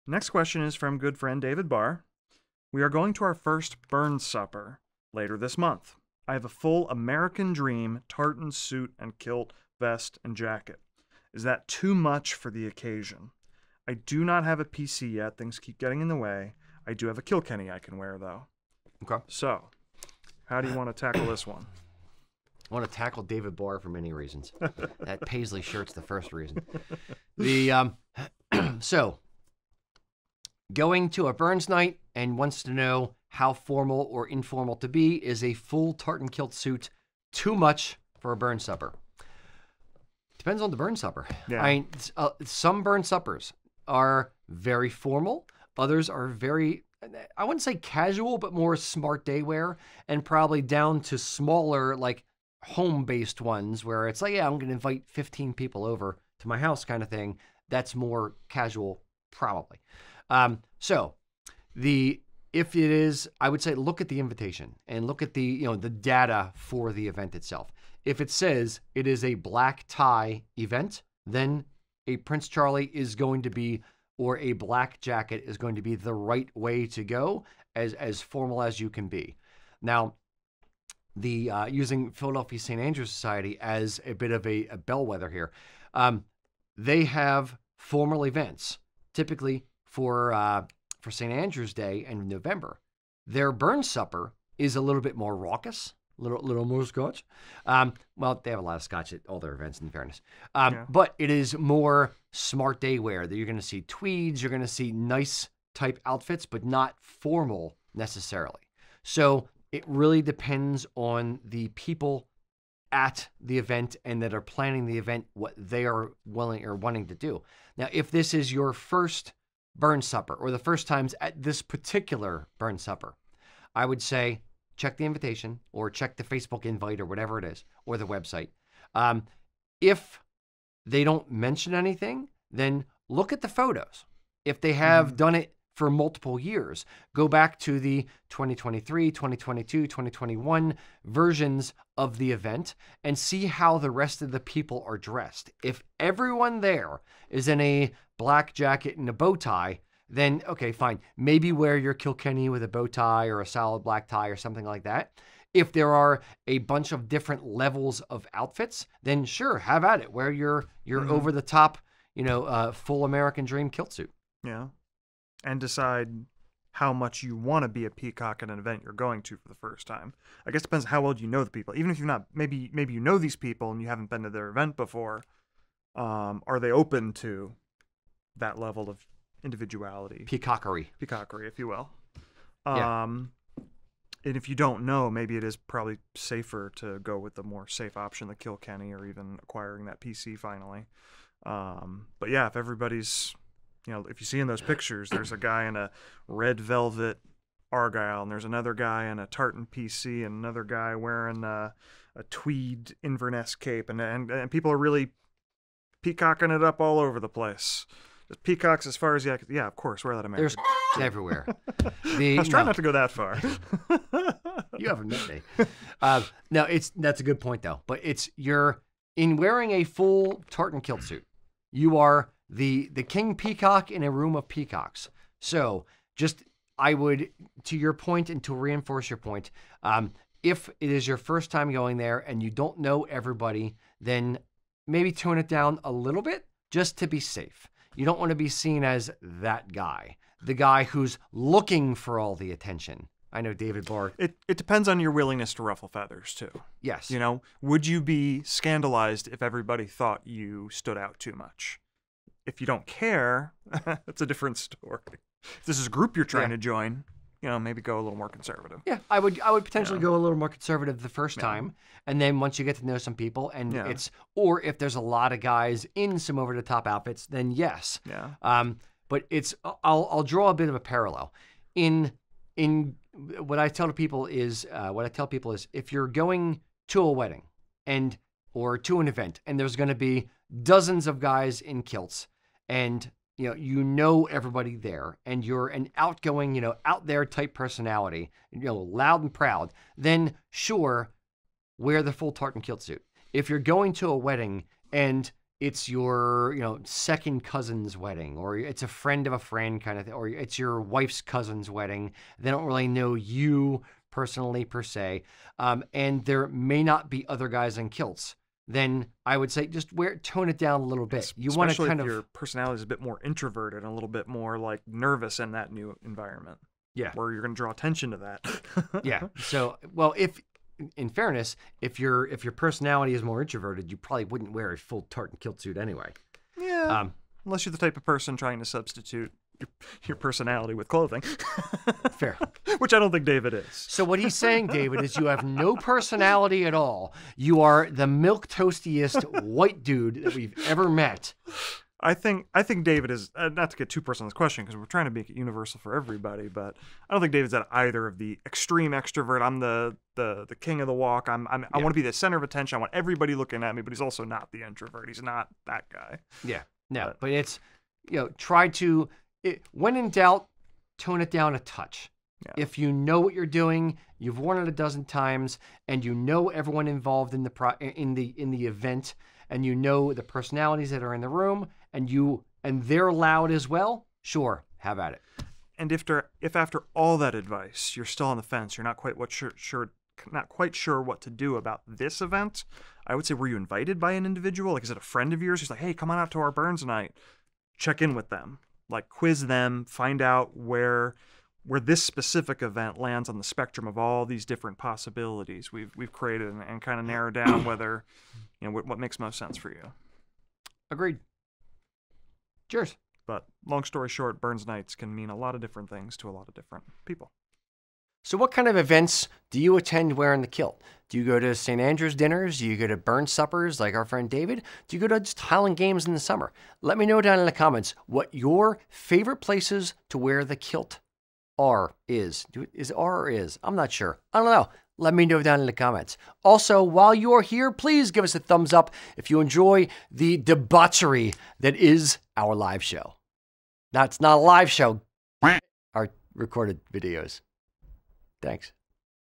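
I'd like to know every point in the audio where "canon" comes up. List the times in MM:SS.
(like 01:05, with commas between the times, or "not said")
not said.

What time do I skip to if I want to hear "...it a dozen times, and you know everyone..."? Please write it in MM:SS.
06:04.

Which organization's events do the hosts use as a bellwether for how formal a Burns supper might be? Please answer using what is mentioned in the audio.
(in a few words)
Philadelphia St. Andrew Society.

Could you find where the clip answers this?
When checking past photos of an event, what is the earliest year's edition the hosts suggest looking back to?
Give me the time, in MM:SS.
02:19.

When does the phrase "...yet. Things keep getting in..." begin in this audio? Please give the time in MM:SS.
00:15.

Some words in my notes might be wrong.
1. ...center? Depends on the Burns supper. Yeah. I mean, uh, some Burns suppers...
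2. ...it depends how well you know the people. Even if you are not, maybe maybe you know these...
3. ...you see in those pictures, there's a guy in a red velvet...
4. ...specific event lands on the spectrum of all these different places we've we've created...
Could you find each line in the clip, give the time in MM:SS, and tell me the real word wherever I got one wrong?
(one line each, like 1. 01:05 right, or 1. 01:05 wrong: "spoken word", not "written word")
1. 00:38 wrong: "supper", not "center"
2. 02:50 right
3. 03:14 right
4. 06:32 wrong: "possibilities", not "places".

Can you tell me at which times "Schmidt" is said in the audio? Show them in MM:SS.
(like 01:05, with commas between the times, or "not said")
not said.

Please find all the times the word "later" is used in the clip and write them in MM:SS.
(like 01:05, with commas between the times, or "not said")
00:05.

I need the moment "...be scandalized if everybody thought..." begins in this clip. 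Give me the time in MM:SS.
04:08.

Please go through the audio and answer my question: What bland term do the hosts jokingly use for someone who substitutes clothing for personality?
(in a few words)
milk toastiest.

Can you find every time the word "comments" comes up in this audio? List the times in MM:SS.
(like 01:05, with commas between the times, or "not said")
06:57, 07:05.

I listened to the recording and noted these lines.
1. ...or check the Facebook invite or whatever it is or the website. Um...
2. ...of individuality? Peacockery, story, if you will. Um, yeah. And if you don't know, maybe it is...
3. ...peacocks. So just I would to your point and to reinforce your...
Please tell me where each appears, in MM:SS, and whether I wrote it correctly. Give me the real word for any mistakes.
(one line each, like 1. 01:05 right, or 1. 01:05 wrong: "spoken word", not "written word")
1. 02:05 right
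2. 02:58 wrong: "peacockery", not "story"
3. 03:44 right.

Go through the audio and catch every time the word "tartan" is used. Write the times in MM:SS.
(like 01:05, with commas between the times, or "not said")
00:08, 00:35, 03:19, 03:40, 04:52, 05:25.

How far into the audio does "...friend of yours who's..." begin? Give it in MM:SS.
06:24.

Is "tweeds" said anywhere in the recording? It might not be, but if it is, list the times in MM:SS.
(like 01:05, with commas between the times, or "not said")
01:43, 03:22.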